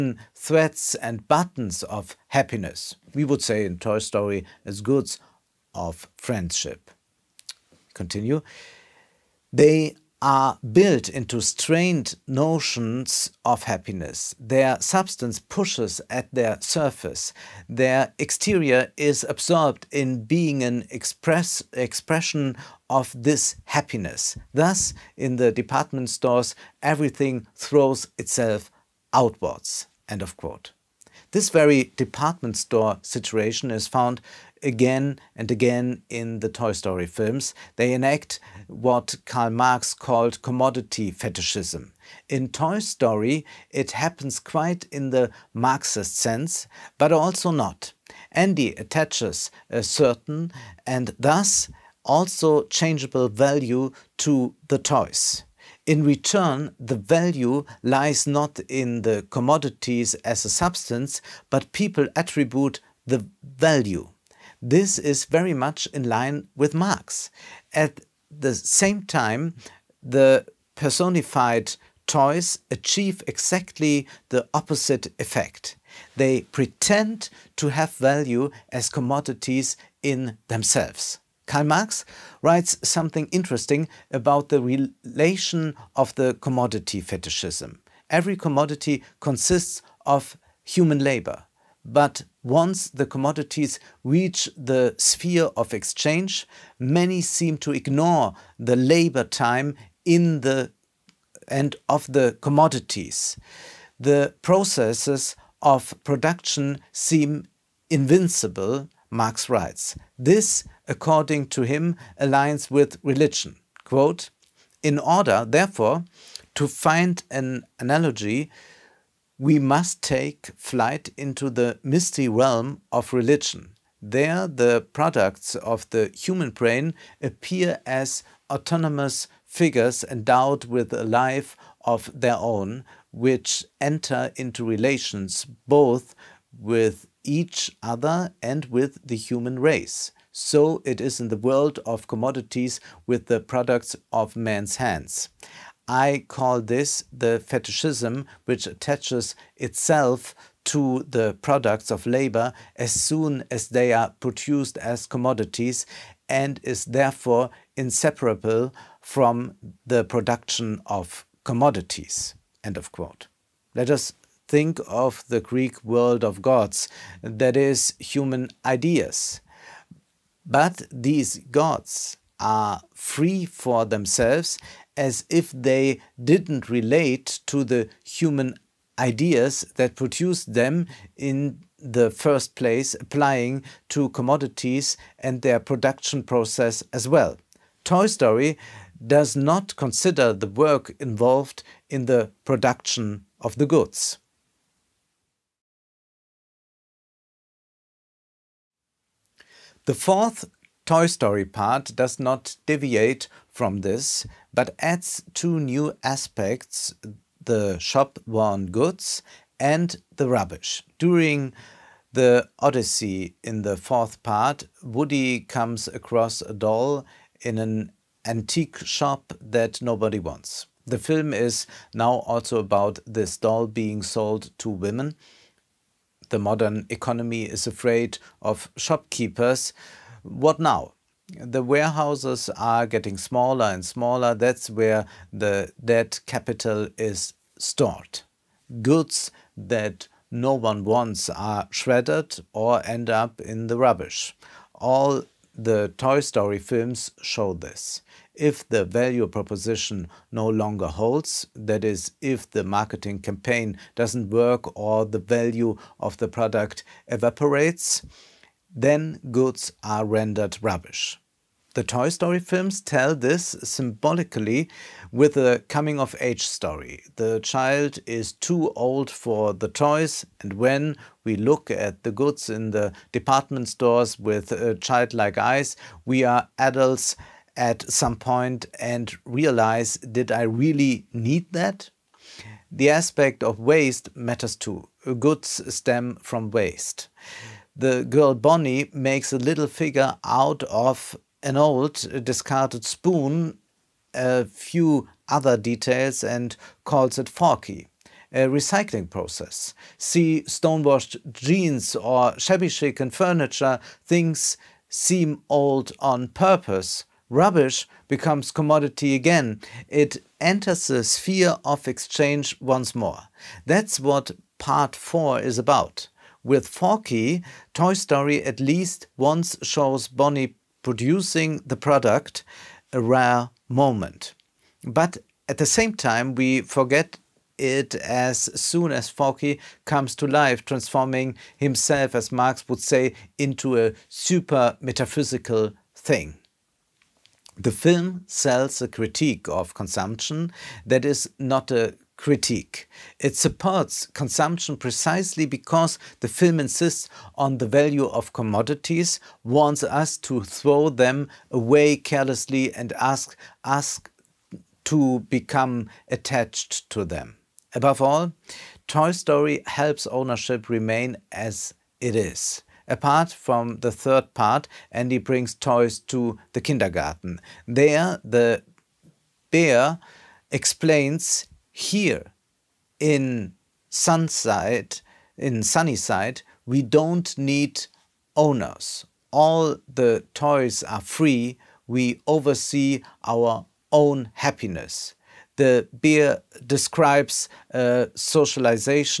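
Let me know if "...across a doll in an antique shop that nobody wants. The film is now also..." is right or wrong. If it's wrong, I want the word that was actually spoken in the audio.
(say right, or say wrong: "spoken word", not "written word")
right.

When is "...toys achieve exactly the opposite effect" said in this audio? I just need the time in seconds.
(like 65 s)
72 s.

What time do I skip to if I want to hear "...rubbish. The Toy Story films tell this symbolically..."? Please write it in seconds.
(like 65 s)
260 s.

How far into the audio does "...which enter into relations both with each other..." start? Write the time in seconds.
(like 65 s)
133 s.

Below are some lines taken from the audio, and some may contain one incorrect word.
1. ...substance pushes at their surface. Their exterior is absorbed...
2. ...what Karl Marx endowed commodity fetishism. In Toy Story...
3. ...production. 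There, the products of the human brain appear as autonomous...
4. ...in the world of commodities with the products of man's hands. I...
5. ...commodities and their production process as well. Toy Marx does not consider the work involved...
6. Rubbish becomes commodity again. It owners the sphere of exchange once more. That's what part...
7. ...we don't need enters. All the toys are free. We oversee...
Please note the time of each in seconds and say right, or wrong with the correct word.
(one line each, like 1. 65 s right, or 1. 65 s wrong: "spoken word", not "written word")
1. 14 s right
2. 38 s wrong: "called", not "endowed"
3. 123 s wrong: "religion", not "production"
4. 141 s right
5. 184 s wrong: "Story", not "Marx"
6. 307 s wrong: "enters", not "owners"
7. 376 s wrong: "owners", not "enters".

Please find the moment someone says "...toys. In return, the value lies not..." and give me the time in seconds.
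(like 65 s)
54 s.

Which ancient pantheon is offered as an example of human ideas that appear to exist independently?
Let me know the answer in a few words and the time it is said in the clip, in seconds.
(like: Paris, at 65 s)
Greek world of gods, at 165 s.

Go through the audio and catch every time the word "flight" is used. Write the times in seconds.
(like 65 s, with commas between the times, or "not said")
120 s.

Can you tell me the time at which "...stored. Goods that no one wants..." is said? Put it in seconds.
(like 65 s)
237 s.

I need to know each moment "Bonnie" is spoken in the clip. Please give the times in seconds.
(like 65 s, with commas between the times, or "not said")
288 s, 320 s.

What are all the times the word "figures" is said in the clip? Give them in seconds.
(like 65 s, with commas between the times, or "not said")
129 s, 289 s.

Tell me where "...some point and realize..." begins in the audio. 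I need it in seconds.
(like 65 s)
277 s.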